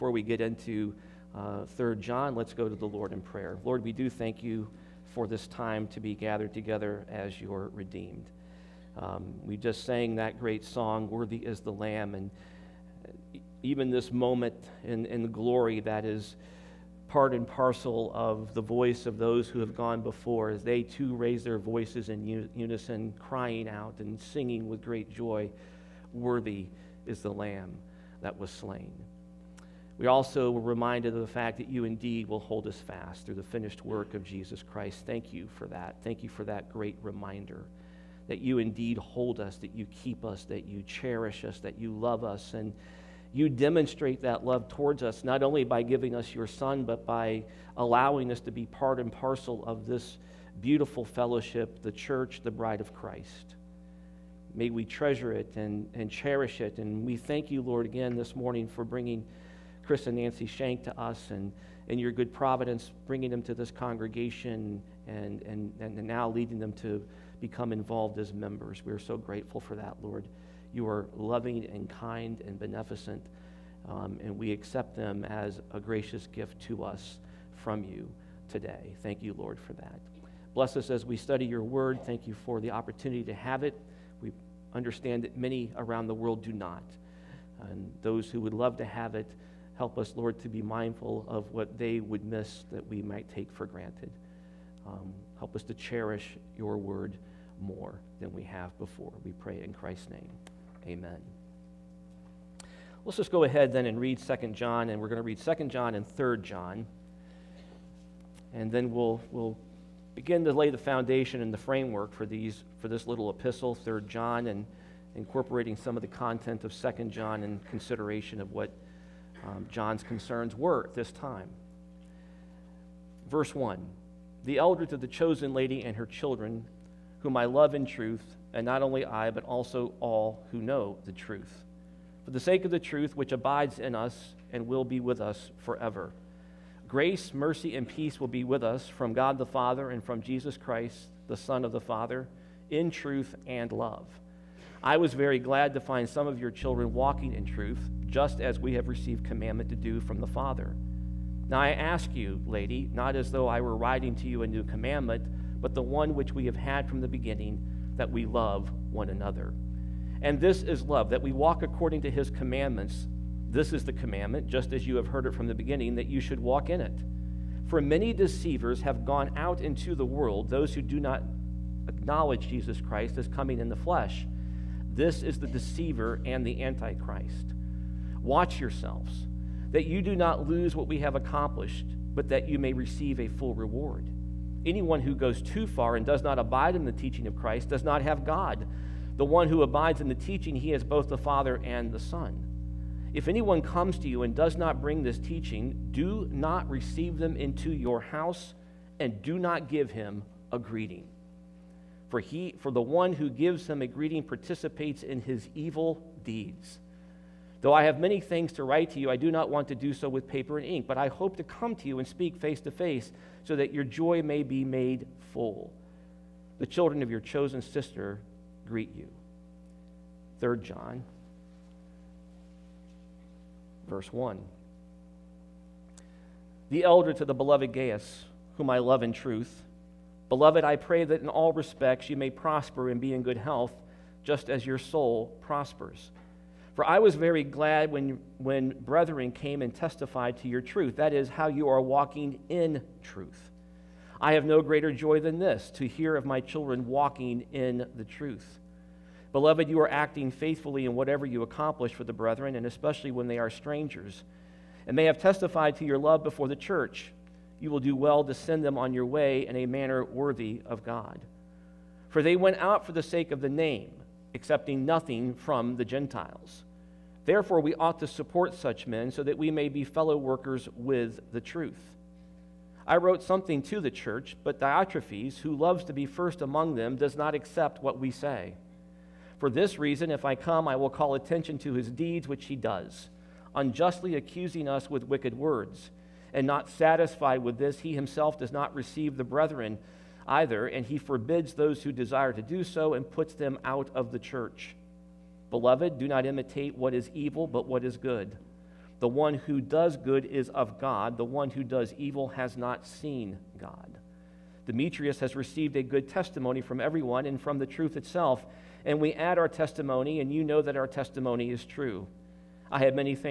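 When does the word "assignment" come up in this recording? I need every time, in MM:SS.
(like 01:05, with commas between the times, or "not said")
not said.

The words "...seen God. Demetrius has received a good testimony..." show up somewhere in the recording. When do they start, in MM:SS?
05:02.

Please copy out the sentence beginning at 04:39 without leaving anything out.
For this reason, if I come, I will call attention to his deeds, which he does, unjustly accusing us with wicked words.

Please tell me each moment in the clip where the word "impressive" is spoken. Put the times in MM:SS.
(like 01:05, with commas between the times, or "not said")
not said.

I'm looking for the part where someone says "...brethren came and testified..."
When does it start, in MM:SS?
03:58.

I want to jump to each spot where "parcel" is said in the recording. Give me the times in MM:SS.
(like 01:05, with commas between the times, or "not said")
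00:17, 00:49.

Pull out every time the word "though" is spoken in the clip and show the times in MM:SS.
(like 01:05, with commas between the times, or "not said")
02:33, 03:27.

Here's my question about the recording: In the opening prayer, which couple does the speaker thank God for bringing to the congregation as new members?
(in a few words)
Chris and Nancy Shank.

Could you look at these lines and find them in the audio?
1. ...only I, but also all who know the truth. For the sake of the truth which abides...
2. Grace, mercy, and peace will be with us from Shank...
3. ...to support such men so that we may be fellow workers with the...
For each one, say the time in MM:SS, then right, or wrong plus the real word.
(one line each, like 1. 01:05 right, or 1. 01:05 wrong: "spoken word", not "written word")
1. 02:08 right
2. 02:16 wrong: "God", not "Shank"
3. 04:27 right.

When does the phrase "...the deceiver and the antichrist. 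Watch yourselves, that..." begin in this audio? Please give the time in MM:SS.
02:55.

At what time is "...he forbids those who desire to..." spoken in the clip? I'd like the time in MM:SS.
04:50.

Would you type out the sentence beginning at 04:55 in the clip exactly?
Beloved, do not imitate what is evil, but what is good.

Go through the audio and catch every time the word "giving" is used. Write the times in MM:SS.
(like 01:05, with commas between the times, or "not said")
00:45.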